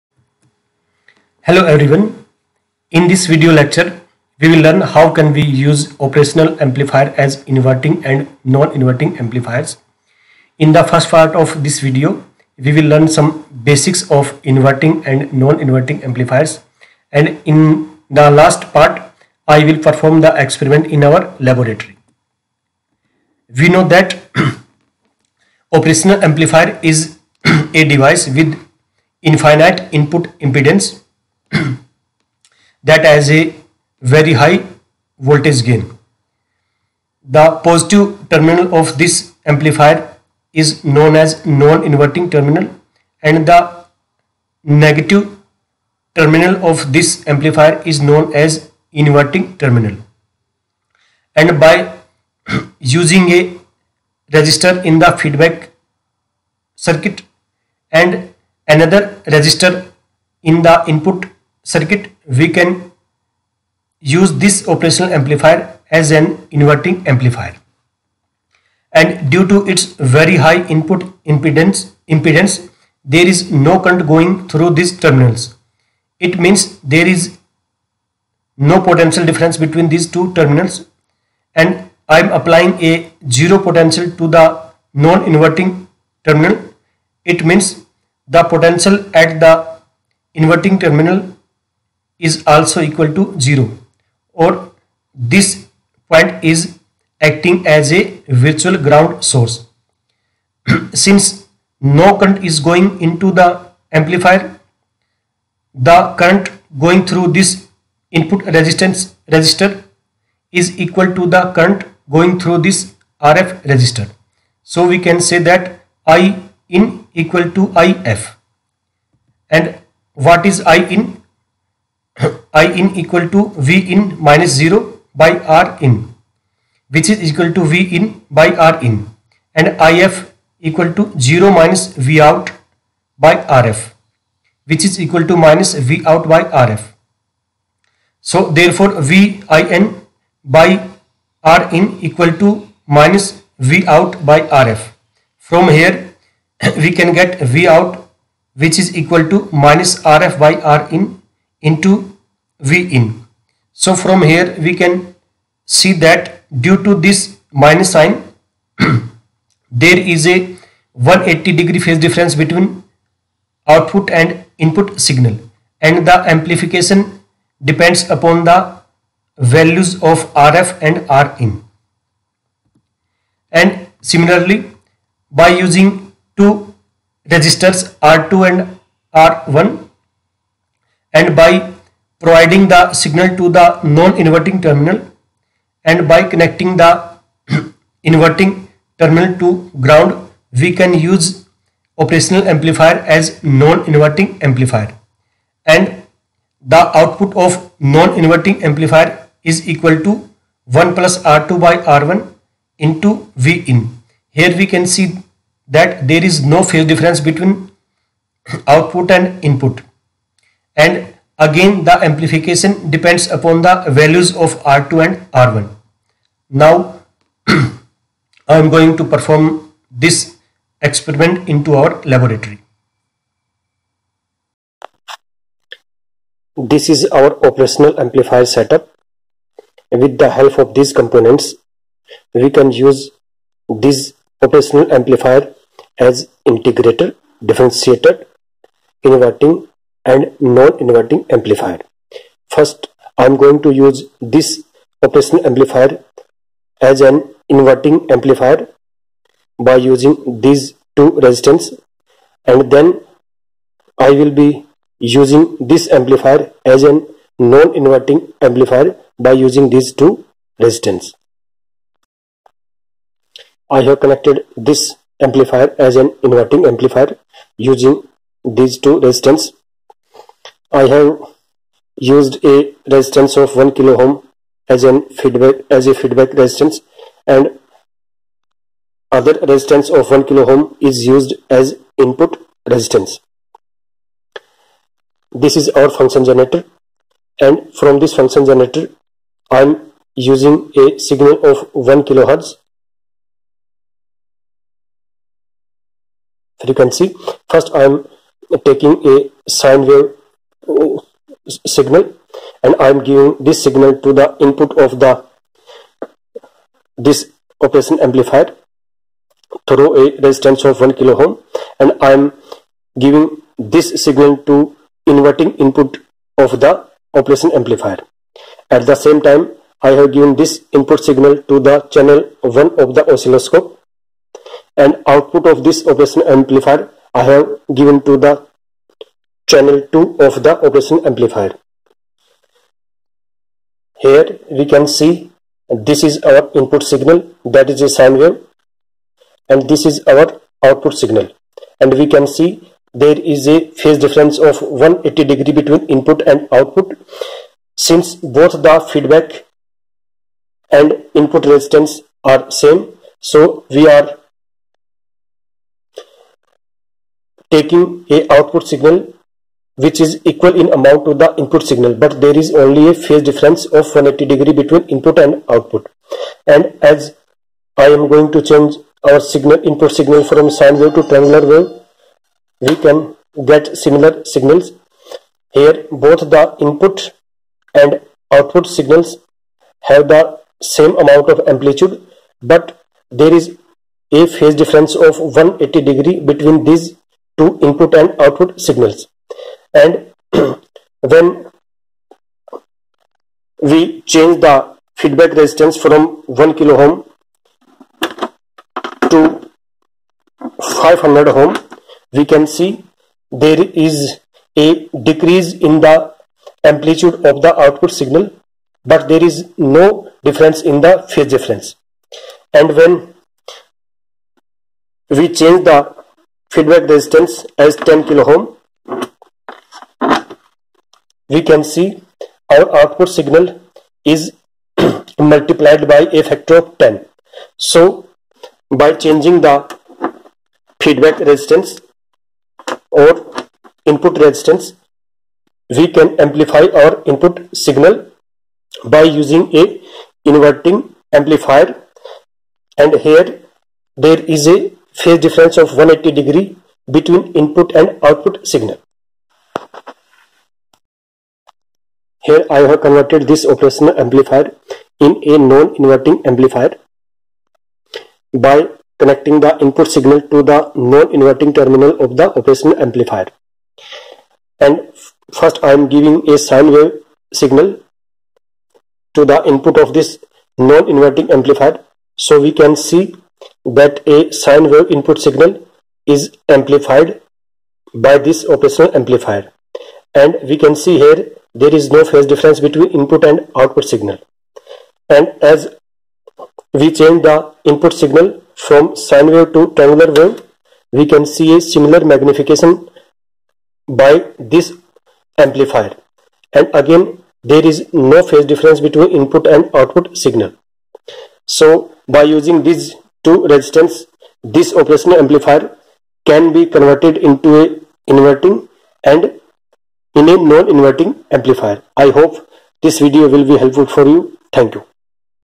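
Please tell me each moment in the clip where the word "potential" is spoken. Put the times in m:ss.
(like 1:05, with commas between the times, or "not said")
1:18, 1:23, 1:28.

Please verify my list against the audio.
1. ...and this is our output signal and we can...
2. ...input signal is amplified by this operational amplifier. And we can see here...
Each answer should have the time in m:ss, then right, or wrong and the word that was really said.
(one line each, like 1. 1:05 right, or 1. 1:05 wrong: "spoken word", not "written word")
1. 5:39 right
2. 7:54 right.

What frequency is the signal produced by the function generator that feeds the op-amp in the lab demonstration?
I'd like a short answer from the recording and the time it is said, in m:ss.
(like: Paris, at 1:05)
1 kilohertz, at 4:51.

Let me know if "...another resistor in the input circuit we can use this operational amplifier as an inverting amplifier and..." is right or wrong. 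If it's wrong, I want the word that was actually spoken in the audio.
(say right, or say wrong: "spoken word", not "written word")
right.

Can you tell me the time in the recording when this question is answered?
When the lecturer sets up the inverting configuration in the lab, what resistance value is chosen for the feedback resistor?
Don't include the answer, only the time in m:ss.
4:33.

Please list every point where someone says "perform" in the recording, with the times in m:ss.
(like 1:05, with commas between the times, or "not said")
0:19, 3:39.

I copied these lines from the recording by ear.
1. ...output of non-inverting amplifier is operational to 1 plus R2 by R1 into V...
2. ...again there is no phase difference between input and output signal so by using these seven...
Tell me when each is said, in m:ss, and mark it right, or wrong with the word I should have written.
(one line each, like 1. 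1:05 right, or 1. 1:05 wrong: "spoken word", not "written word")
1. 3:16 wrong: "equal", not "operational"
2. 8:16 wrong: "two", not "seven".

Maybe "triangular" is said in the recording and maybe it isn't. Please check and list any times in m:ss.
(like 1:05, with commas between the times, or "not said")
6:11, 8:09.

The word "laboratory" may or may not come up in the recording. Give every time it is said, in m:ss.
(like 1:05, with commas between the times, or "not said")
0:21, 3:42.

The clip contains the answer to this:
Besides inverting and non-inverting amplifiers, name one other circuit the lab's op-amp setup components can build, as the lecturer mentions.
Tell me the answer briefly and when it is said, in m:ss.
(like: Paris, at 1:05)
integrator, at 3:56.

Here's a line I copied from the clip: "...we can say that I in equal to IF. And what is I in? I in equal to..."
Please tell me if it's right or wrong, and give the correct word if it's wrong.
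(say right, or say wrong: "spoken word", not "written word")
right.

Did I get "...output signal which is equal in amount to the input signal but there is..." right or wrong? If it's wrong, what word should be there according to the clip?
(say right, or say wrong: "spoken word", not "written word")
right.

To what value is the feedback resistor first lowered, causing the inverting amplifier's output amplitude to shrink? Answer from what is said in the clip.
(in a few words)
500 ohm.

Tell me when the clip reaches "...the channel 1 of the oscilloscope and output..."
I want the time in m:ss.
5:21.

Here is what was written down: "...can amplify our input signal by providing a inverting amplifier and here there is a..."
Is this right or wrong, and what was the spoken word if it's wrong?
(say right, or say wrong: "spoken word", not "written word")
wrong: "using", not "providing".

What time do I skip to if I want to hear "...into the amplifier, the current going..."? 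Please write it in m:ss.
1:43.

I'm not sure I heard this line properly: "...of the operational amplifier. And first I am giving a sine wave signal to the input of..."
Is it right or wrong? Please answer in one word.
right.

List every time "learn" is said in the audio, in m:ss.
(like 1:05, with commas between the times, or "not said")
0:04, 0:12.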